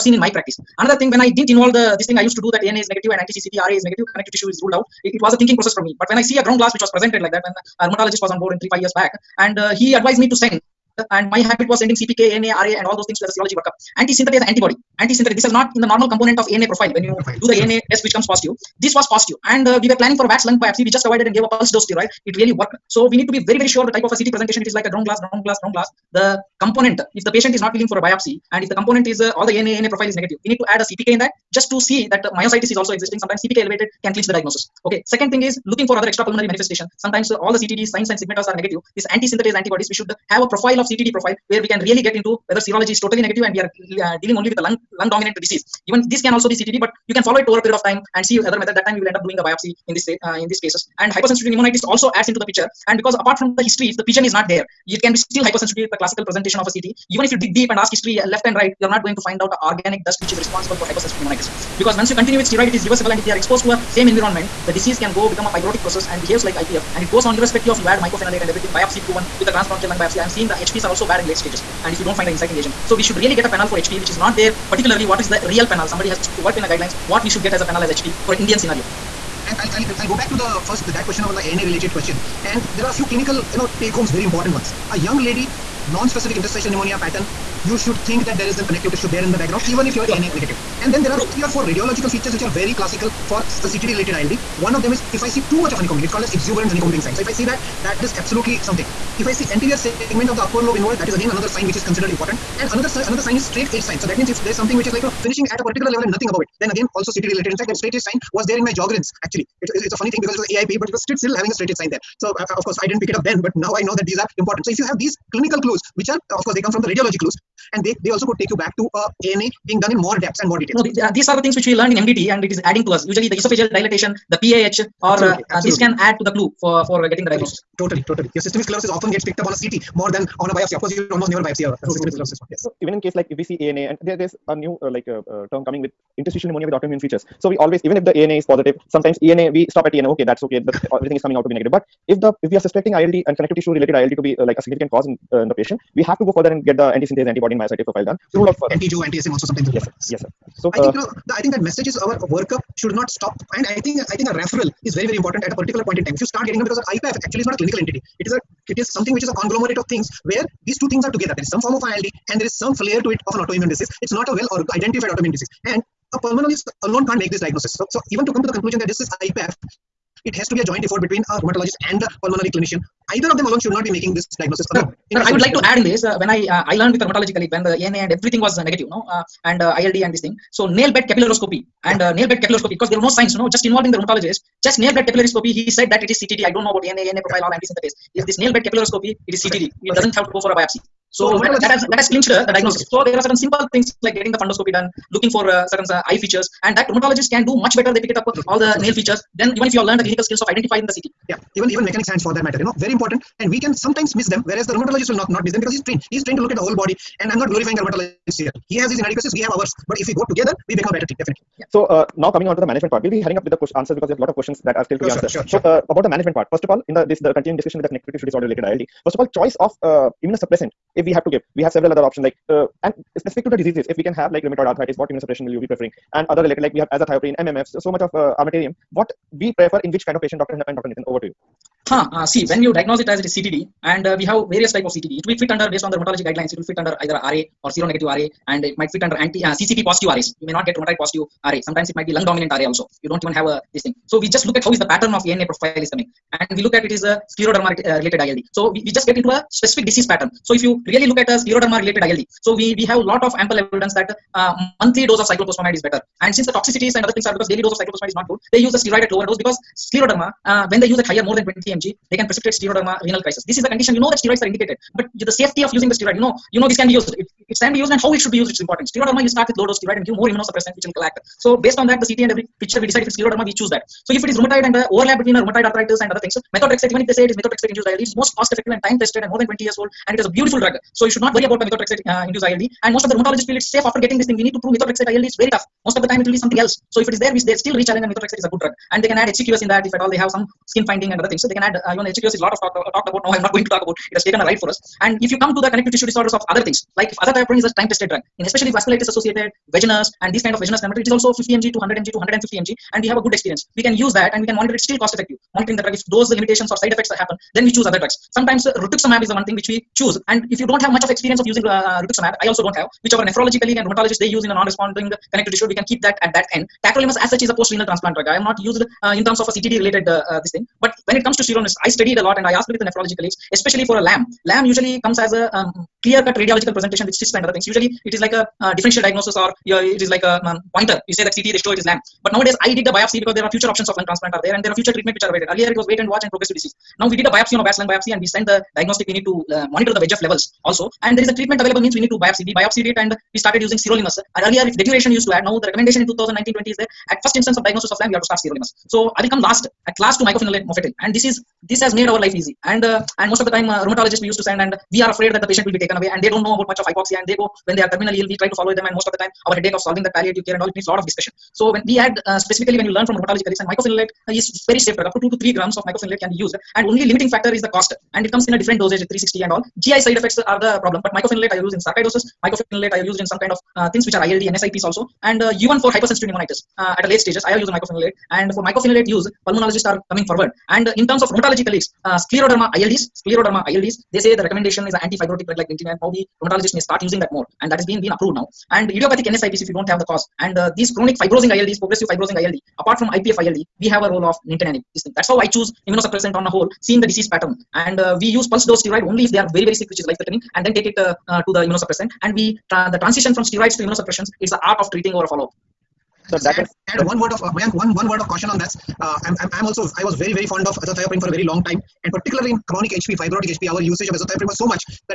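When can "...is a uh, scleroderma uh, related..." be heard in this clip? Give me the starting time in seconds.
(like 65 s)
246 s.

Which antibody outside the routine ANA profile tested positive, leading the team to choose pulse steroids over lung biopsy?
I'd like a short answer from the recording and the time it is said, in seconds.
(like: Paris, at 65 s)
Anti-synthetase antibody, at 14 s.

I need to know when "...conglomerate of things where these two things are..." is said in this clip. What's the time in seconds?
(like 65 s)
159 s.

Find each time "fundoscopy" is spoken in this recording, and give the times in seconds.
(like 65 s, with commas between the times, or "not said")
194 s.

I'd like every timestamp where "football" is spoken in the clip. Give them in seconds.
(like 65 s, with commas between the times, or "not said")
not said.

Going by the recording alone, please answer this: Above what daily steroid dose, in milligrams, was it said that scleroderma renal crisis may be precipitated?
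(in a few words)
20 mg.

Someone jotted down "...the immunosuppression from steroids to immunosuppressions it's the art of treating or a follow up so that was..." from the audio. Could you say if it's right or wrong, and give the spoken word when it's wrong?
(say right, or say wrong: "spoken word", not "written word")
wrong: "transition", not "immunosuppression".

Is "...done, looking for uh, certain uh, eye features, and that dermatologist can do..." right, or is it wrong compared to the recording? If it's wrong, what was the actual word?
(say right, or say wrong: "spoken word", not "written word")
right.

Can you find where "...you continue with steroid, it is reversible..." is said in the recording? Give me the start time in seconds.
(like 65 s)
62 s.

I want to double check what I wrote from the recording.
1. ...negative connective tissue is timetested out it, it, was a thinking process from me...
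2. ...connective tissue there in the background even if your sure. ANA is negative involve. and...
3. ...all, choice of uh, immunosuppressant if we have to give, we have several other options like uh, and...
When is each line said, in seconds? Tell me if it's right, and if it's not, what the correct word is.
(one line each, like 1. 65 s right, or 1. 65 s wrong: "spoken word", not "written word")
1. 3 s wrong: "ruled", not "timetested"
2. 88 s wrong: "negative", not "involve"
3. 219 s right.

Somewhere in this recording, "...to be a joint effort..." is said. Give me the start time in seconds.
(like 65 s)
170 s.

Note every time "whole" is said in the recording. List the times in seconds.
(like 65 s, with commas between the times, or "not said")
206 s, 396 s.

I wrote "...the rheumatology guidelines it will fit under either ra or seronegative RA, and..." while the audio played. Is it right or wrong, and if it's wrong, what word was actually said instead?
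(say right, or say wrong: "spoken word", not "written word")
right.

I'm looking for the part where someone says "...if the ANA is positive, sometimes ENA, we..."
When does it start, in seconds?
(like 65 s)
137 s.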